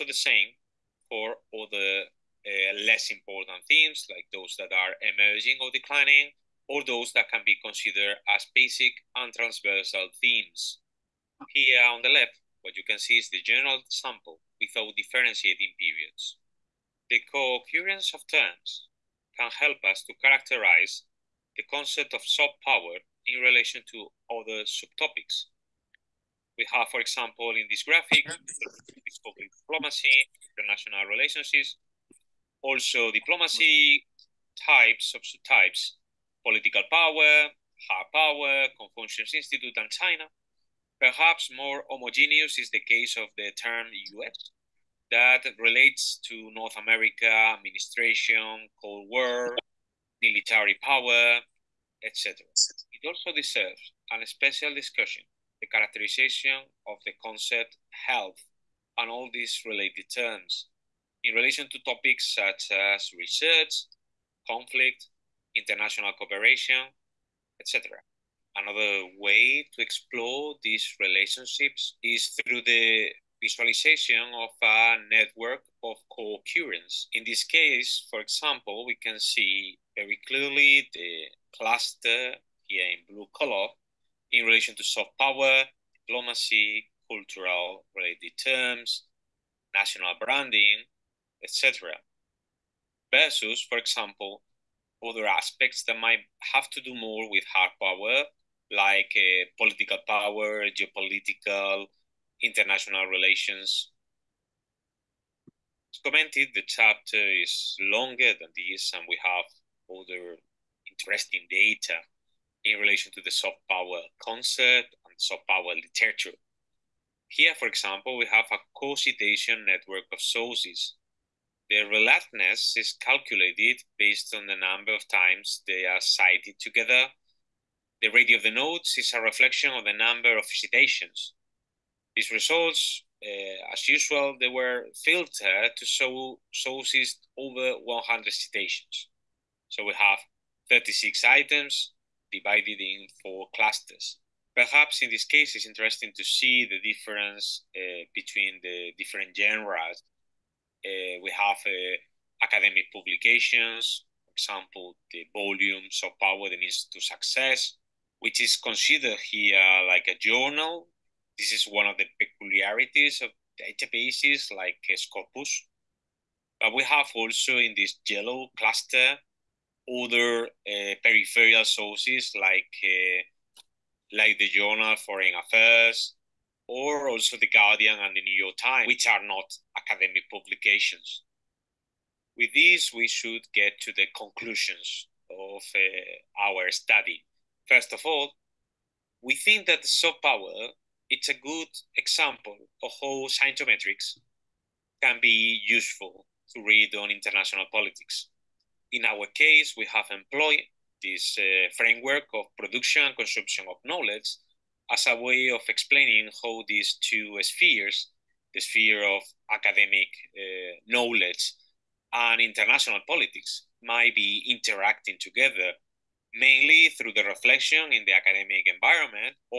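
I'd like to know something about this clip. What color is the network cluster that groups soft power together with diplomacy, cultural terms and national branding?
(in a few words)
Blue.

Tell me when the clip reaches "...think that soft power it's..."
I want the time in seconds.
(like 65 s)
189 s.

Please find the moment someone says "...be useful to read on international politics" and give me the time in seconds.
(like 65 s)
195 s.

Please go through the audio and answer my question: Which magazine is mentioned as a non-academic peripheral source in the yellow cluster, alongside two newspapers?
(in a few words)
Foreign Affairs.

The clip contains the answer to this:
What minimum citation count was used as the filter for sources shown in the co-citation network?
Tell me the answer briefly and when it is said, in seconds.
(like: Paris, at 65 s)
100, at 137 s.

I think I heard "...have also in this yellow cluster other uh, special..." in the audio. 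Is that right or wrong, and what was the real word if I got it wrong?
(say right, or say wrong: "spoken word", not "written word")
wrong: "peripheral", not "special".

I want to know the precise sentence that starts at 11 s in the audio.
Here on the left, what you can see is the general sample without differentiating periods.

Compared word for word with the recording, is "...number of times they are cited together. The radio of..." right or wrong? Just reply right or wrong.
right.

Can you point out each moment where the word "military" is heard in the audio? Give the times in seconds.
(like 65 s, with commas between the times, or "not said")
50 s.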